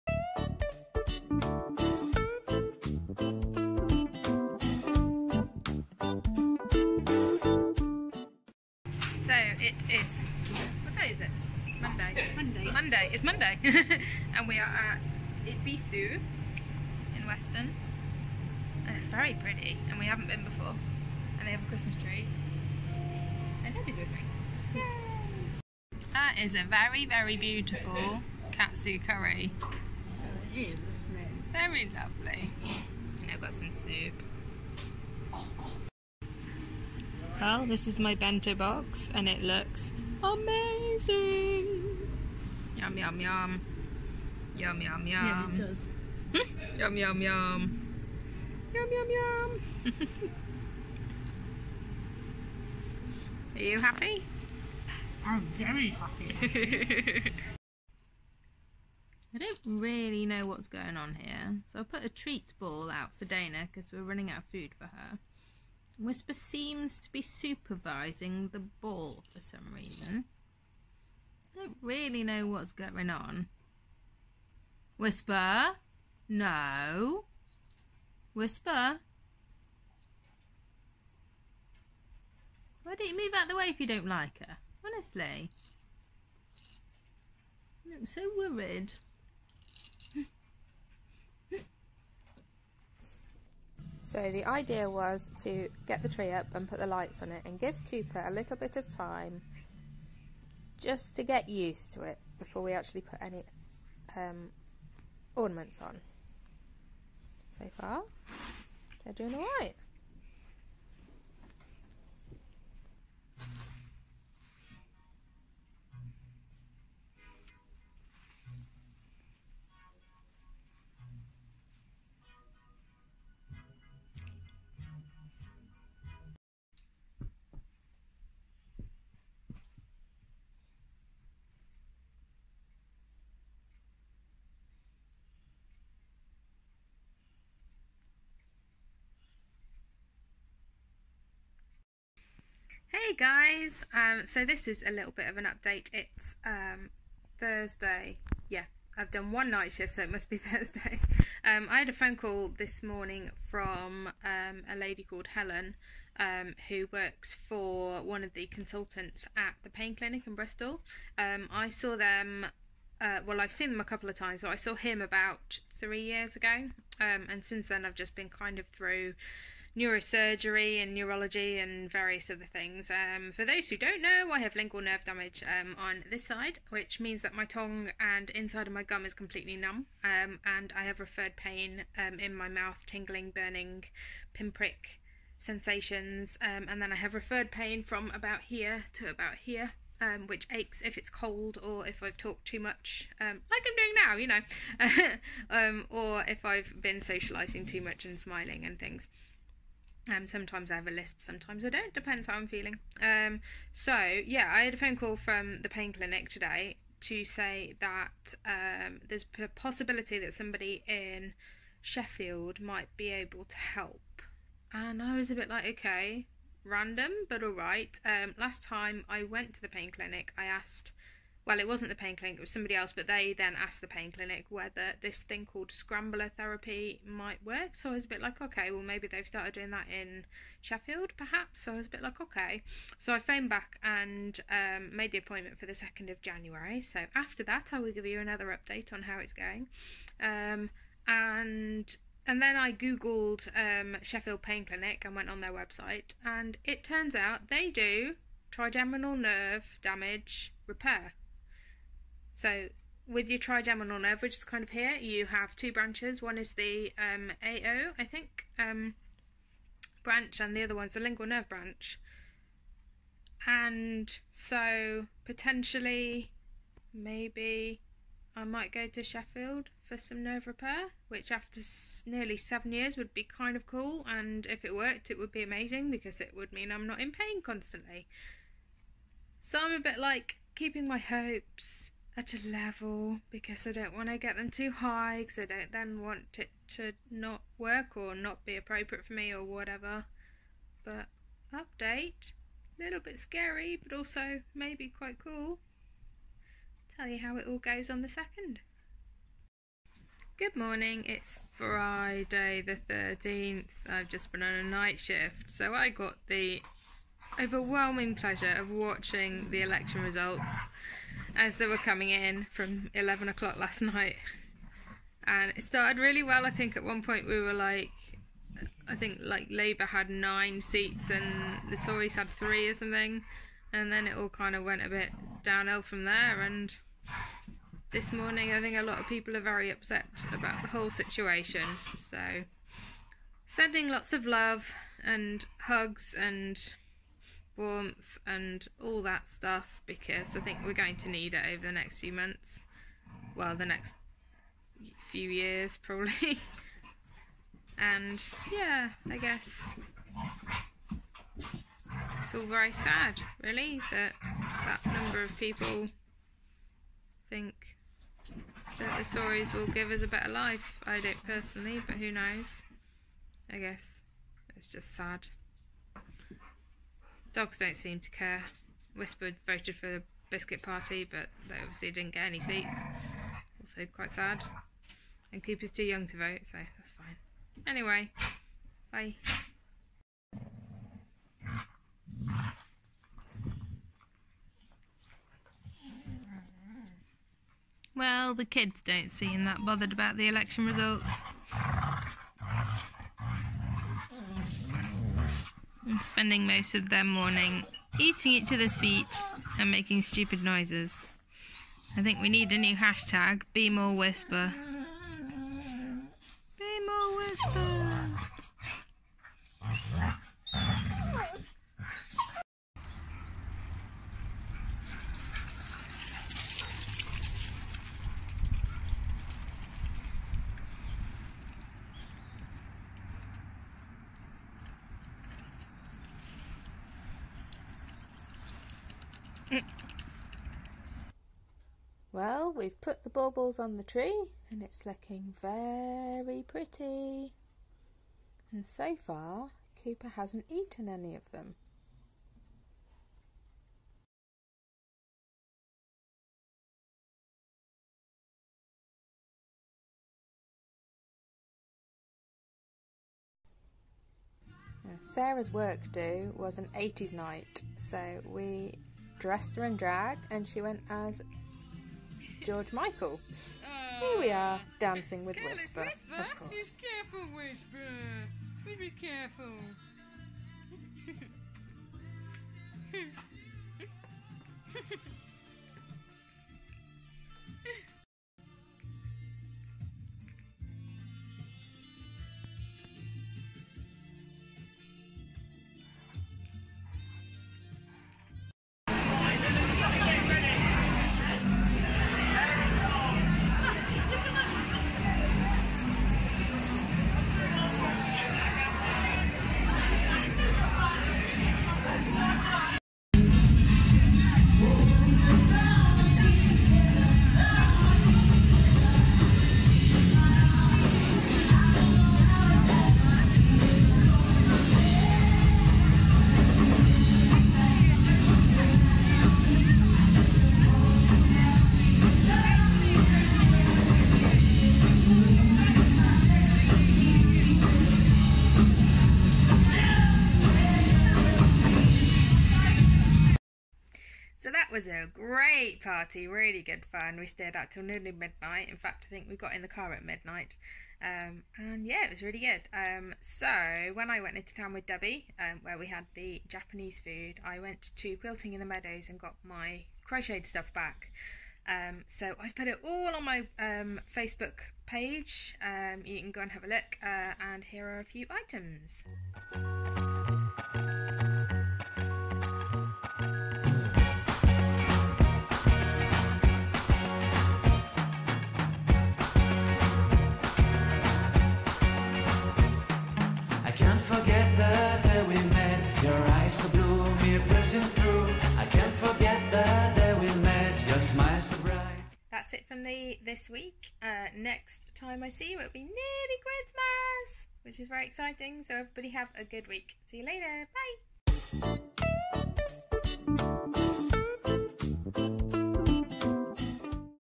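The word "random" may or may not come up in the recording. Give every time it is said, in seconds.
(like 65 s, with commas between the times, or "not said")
216 s.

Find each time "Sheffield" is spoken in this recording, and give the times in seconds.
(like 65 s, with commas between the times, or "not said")
211 s, 230 s, 244 s, 269 s.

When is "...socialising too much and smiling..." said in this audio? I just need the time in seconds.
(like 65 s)
197 s.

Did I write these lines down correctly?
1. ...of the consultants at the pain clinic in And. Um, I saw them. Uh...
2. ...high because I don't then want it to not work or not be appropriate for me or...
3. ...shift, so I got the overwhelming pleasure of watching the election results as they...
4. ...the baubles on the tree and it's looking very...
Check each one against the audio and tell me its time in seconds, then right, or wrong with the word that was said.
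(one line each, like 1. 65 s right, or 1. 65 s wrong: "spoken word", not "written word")
1. 158 s wrong: "Bristol", not "And"
2. 284 s right
3. 304 s right
4. 433 s right.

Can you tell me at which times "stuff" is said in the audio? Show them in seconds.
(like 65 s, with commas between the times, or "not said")
339 s, 550 s.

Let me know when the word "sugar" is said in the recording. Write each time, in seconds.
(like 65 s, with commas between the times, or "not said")
not said.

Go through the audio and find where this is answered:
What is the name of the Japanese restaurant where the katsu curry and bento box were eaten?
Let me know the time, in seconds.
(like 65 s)
15 s.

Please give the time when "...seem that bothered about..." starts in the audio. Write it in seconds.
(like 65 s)
389 s.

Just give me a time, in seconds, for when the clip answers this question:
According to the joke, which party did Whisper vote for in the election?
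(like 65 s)
370 s.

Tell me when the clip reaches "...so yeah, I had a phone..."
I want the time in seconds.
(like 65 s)
203 s.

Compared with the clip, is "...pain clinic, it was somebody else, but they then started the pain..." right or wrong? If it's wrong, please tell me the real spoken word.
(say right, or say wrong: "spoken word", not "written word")
wrong: "asked", not "started".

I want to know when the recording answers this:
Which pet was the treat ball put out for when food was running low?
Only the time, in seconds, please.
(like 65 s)
63 s.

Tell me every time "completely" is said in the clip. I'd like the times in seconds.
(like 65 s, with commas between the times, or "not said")
179 s.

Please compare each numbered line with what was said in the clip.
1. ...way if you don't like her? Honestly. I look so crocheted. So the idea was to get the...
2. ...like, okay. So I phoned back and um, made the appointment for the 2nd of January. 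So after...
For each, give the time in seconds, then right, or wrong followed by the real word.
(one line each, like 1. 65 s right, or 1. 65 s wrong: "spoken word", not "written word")
1. 83 s wrong: "worried", not "crocheted"
2. 232 s right.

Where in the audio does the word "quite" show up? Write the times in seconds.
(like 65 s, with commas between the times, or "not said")
294 s, 373 s.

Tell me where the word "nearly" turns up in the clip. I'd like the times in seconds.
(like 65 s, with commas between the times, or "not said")
272 s, 537 s, 585 s.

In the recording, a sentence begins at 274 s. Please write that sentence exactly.
And if it worked, it would be amazing because it would mean I'm not in pain constantly.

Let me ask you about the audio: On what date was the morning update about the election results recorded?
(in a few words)
Friday the 13th.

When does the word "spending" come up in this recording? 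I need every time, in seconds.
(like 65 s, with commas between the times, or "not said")
396 s.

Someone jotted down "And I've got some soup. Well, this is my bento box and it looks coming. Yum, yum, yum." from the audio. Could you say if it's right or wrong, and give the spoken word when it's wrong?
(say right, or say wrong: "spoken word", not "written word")
wrong: "amazing", not "coming".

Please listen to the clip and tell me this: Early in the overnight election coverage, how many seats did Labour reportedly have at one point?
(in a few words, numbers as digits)
9.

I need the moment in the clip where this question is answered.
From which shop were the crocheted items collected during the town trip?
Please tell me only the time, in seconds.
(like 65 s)
548 s.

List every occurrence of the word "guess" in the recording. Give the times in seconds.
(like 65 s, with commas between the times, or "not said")
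349 s, 363 s.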